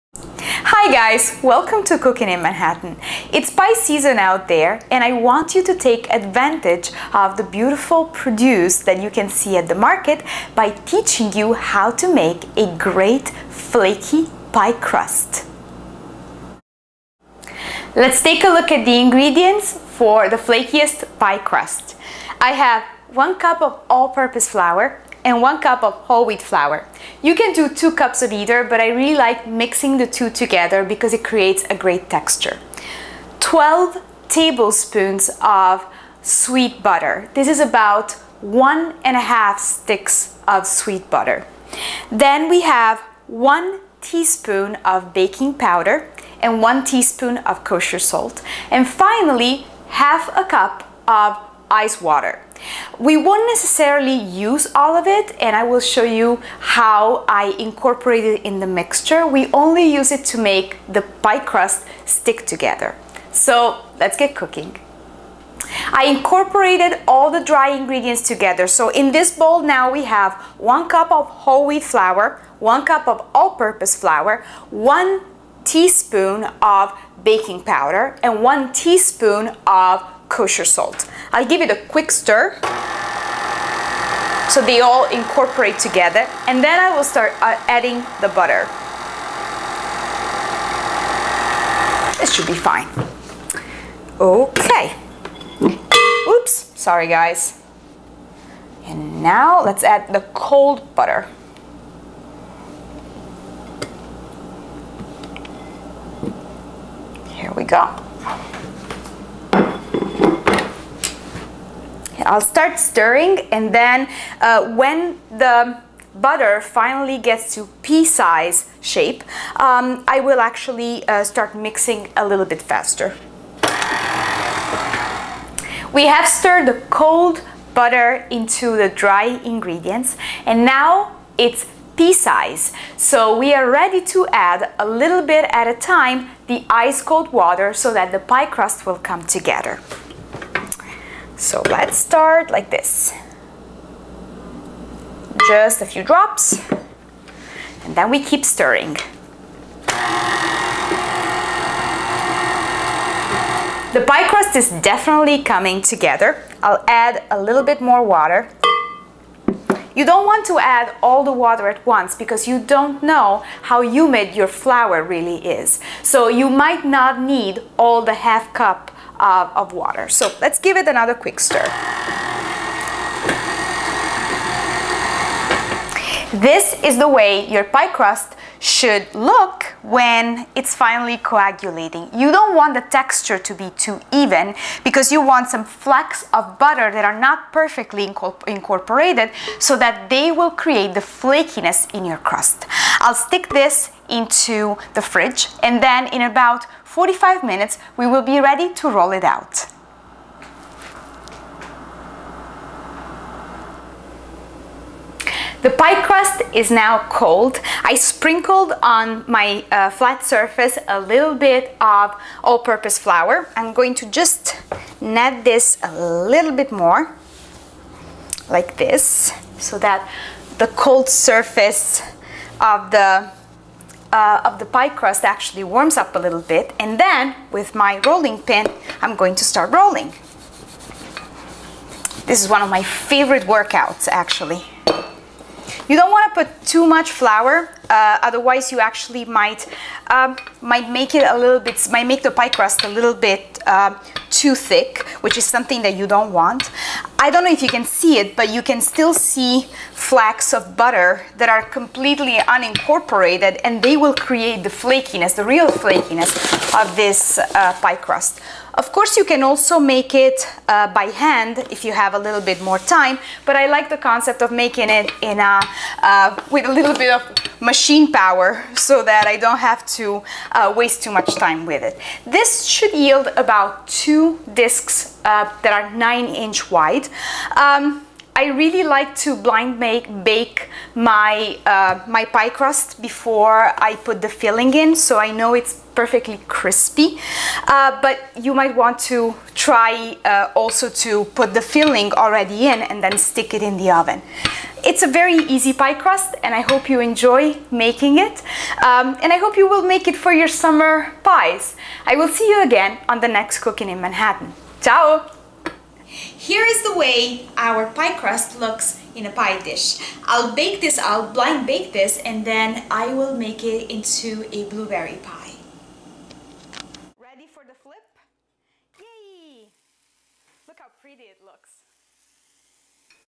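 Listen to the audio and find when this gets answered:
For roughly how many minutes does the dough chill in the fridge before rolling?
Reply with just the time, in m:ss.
3:16.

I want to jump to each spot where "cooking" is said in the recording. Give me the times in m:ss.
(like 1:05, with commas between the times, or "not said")
0:01, 1:04, 5:03.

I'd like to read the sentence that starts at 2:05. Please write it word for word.
We have stirred the cold butter into the dry ingredients and now it's pea size.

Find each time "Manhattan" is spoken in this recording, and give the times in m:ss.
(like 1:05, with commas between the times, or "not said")
0:02, 5:03.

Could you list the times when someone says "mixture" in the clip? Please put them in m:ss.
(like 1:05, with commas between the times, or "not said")
0:58.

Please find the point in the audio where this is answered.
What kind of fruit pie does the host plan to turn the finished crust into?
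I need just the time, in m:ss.
5:14.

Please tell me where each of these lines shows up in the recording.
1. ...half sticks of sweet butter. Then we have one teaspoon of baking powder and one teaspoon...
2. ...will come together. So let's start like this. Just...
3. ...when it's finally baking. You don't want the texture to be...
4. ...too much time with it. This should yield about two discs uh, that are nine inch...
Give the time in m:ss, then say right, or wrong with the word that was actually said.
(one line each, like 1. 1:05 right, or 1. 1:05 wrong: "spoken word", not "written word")
1. 0:39 right
2. 2:18 right
3. 2:59 wrong: "coagulating", not "baking"
4. 4:31 right.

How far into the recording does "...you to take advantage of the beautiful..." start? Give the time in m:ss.
0:05.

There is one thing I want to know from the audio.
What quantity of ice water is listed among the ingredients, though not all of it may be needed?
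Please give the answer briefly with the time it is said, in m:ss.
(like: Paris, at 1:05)
half a cup, at 0:49.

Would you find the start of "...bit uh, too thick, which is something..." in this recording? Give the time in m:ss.
4:03.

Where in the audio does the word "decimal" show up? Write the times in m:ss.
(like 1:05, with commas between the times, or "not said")
not said.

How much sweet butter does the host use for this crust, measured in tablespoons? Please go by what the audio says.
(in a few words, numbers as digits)
12 tablespoons.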